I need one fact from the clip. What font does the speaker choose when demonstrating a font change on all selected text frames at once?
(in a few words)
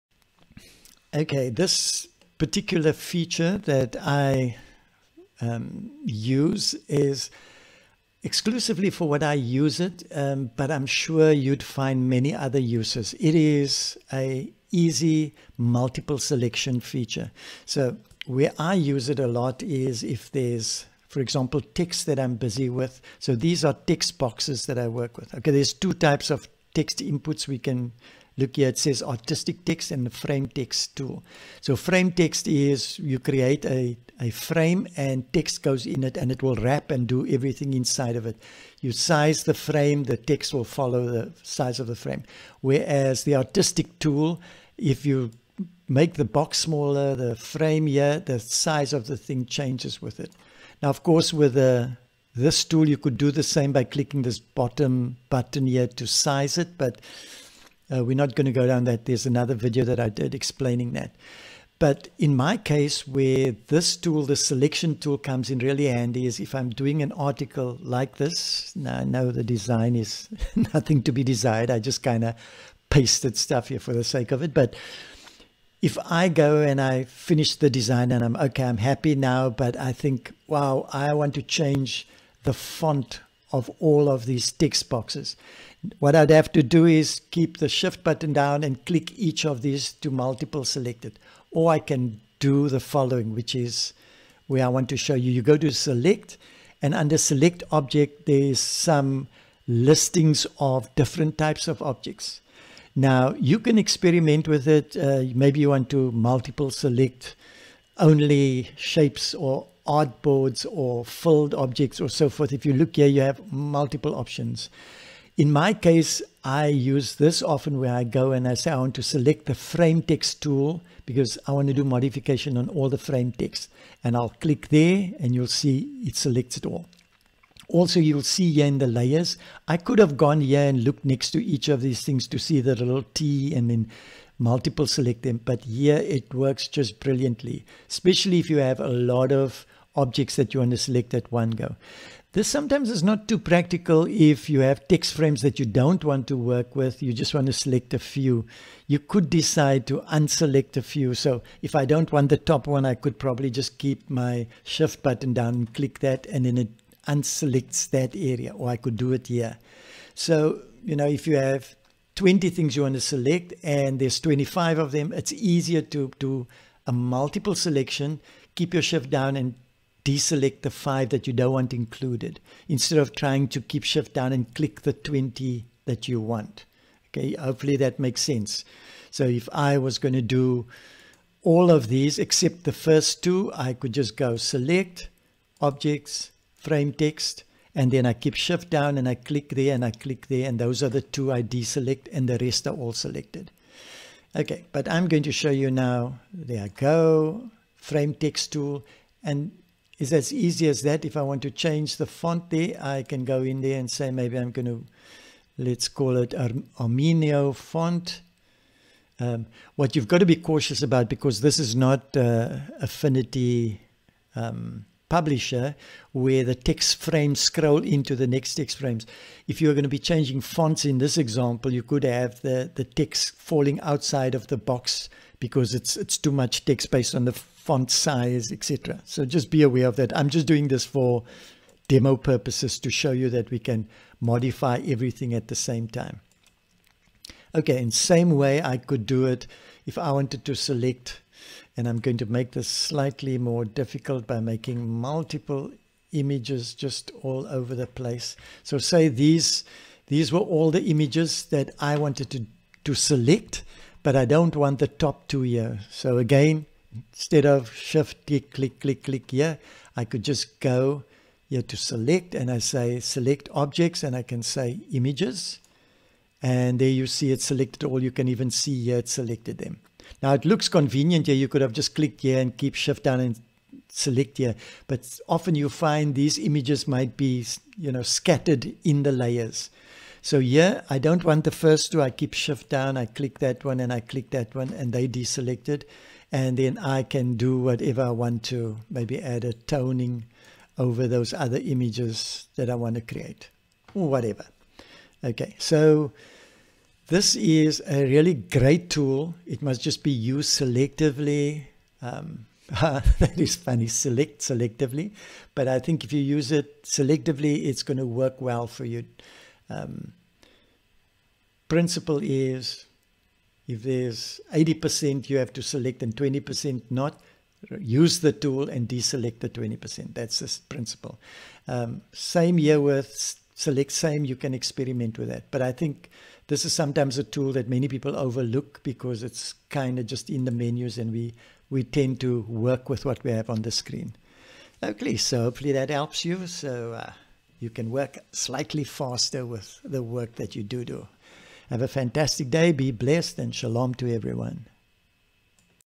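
Armenio.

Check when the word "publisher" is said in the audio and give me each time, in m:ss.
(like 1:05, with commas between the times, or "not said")
3:35.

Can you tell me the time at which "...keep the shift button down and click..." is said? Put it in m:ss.
1:27.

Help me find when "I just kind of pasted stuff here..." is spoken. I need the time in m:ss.
1:11.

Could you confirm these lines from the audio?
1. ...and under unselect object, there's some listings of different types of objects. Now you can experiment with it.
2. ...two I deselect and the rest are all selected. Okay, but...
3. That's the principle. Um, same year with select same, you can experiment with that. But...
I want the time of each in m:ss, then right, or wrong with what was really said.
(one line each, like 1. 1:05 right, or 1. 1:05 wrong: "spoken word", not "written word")
1. 1:36 wrong: "select", not "unselect"
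2. 3:11 right
3. 5:20 right.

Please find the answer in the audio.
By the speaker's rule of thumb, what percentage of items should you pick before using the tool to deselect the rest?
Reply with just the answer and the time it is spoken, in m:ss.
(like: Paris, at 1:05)
80%, at 5:14.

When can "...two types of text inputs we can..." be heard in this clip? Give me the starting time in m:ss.
0:25.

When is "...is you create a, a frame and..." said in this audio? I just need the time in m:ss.
0:32.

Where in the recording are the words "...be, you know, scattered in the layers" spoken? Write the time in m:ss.
4:37.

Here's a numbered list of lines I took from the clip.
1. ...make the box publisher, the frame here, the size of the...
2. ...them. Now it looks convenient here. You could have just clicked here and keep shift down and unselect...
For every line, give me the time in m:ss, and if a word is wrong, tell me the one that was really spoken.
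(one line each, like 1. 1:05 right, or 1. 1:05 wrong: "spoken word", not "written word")
1. 0:45 wrong: "smaller", not "publisher"
2. 4:29 wrong: "select", not "unselect".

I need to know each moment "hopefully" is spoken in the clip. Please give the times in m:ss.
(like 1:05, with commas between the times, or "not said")
2:57, 5:35.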